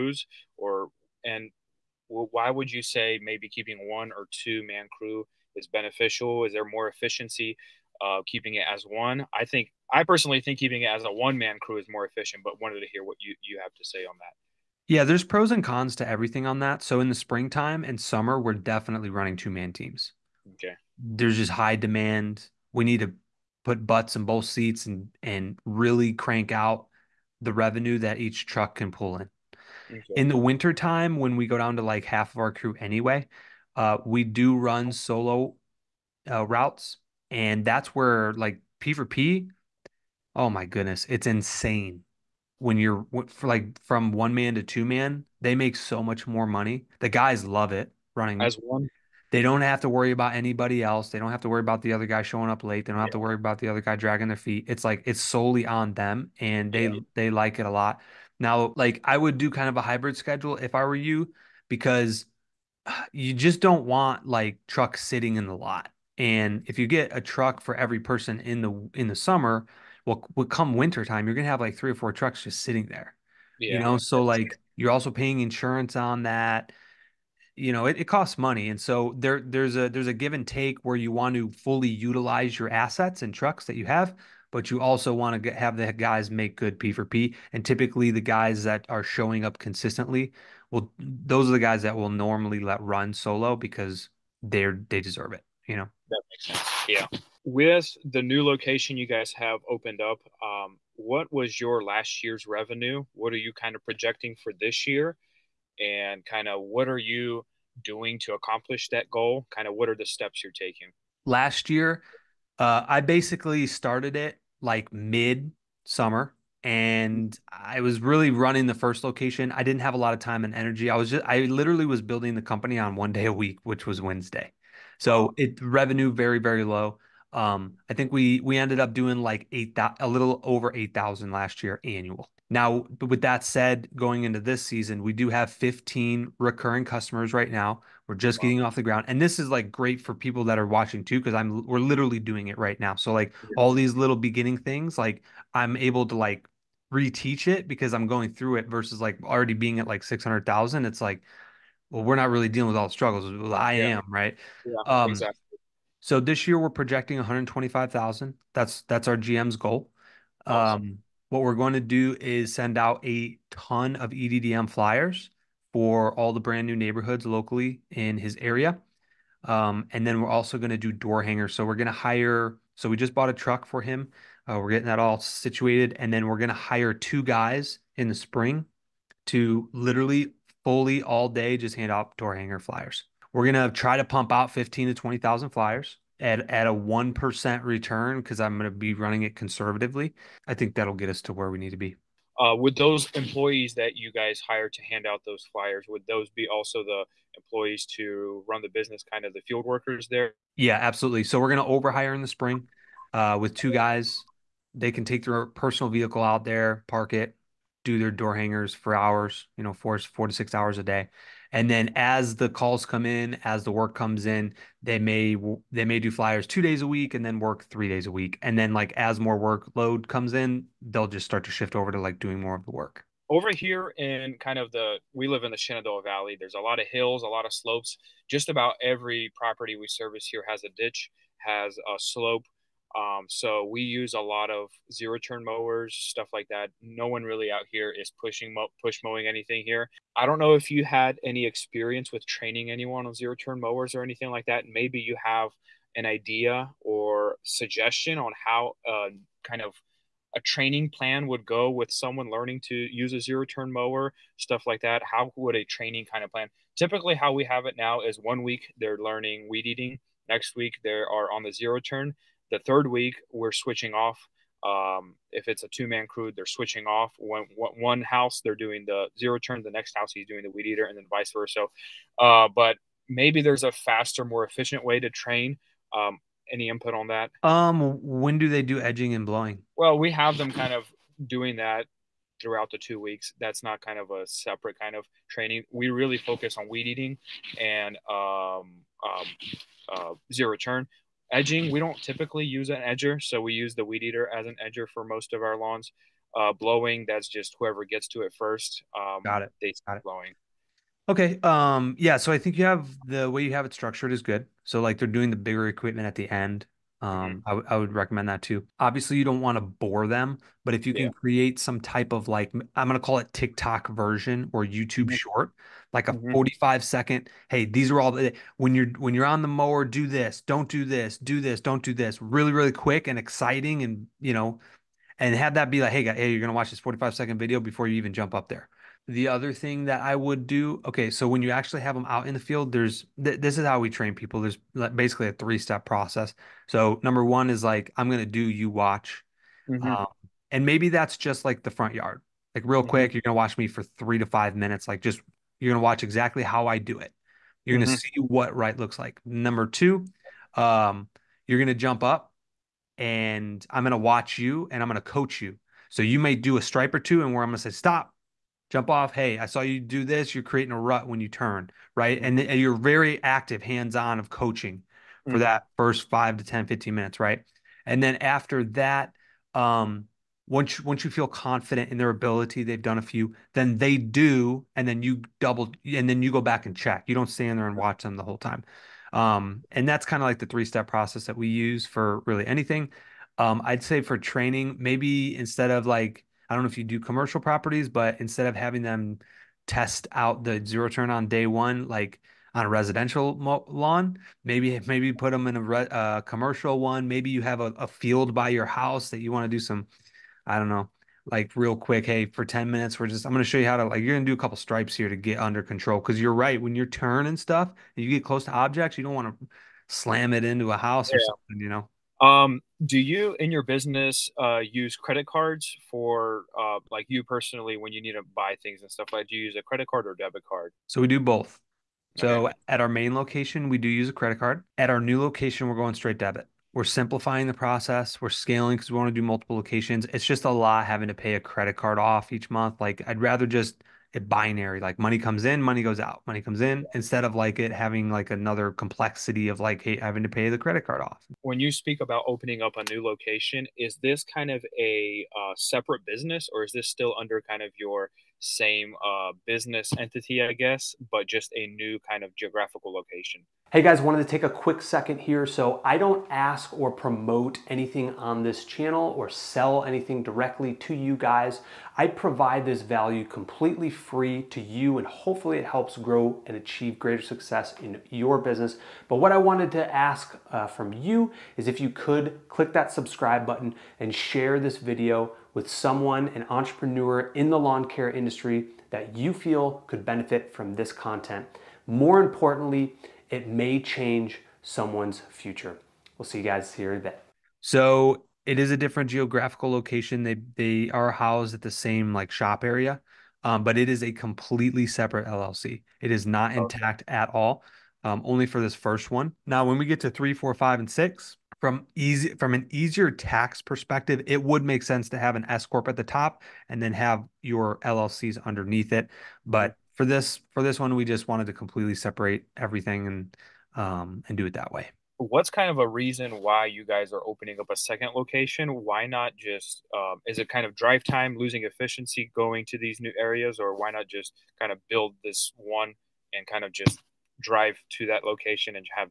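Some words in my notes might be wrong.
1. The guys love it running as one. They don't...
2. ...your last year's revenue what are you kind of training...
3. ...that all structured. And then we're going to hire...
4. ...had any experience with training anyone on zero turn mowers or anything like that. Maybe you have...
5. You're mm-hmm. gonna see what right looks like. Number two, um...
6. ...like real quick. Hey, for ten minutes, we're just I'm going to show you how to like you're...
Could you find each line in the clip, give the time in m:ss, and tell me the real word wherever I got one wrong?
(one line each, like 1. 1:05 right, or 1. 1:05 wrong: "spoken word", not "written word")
1. 0:46 right
2. 1:41 wrong: "projecting", not "training"
3. 2:54 wrong: "situated", not "structured"
4. 4:00 right
5. 5:47 right
6. 6:41 right.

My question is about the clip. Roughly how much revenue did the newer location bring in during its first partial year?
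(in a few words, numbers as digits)
8,000.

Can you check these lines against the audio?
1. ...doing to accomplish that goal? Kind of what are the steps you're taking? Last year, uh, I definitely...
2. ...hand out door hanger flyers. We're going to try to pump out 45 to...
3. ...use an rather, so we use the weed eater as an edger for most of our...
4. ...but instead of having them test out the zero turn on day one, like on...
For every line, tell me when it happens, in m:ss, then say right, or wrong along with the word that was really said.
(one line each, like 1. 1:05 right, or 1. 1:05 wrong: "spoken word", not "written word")
1. 1:47 wrong: "basically", not "definitely"
2. 3:01 wrong: "15", not "45"
3. 4:52 wrong: "edger", not "rather"
4. 6:27 right.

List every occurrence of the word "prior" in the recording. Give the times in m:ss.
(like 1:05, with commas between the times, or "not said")
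not said.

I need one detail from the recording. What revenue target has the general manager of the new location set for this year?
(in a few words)
125,000.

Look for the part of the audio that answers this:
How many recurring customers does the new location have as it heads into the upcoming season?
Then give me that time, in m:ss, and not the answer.
2:15.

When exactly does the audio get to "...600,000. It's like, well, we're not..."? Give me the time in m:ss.
2:30.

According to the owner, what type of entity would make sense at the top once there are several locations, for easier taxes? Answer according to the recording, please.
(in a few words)
S corp.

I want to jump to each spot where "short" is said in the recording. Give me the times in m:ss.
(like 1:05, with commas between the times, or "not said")
5:15.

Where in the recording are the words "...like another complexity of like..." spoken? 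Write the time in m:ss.
7:18.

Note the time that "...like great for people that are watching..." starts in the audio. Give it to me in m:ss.
2:19.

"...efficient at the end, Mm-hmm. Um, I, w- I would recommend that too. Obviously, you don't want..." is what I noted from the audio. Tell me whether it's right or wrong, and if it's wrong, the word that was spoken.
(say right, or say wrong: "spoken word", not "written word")
wrong: "equipment", not "efficient".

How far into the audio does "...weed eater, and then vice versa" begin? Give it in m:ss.
4:30.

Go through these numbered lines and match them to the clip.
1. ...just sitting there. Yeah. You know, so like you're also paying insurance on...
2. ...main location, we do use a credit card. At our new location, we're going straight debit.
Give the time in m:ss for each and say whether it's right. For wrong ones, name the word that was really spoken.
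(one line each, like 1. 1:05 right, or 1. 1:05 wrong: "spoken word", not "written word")
1. 1:12 right
2. 7:02 right.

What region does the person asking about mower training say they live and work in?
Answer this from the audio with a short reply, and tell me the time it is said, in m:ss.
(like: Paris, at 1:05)
Shenandoah Valley, at 3:45.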